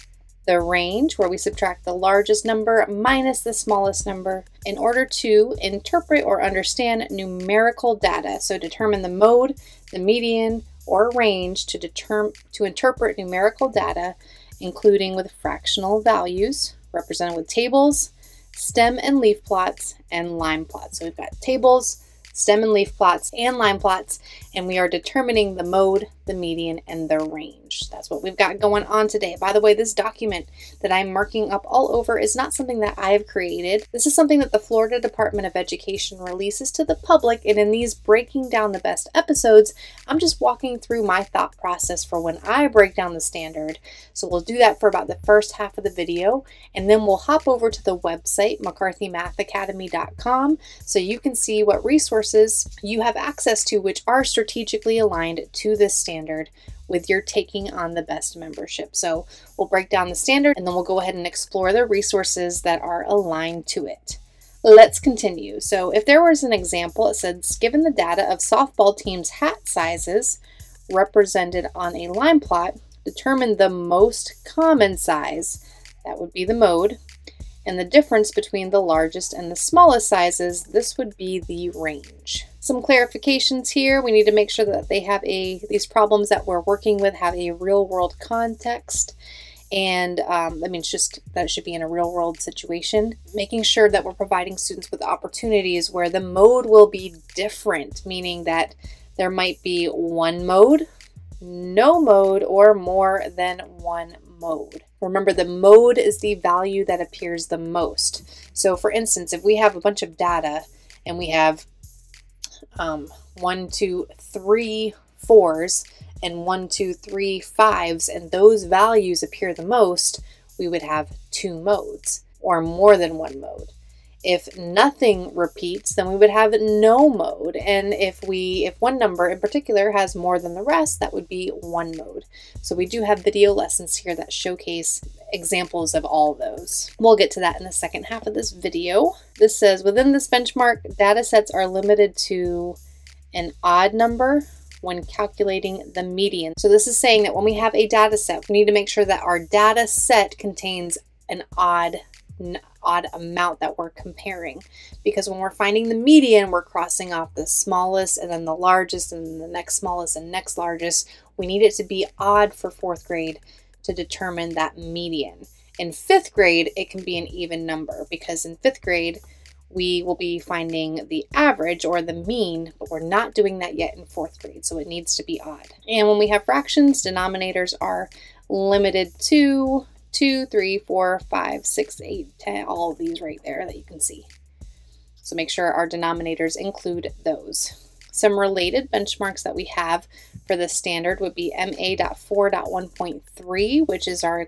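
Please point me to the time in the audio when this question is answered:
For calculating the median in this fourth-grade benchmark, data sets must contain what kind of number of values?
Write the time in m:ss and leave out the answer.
2:23.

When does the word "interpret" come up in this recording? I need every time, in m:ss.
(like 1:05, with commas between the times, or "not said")
0:05, 0:12.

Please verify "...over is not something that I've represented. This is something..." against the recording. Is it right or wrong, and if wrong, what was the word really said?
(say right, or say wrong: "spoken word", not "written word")
wrong: "created", not "represented".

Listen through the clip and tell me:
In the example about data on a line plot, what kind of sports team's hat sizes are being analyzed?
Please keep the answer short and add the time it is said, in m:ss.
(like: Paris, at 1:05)
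Softball, at 1:08.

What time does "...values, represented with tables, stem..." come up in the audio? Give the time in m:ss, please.
0:16.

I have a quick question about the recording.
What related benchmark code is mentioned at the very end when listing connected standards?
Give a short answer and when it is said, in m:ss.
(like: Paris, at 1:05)
MA.4.1.3, at 3:11.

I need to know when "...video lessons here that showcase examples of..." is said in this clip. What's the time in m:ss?
2:13.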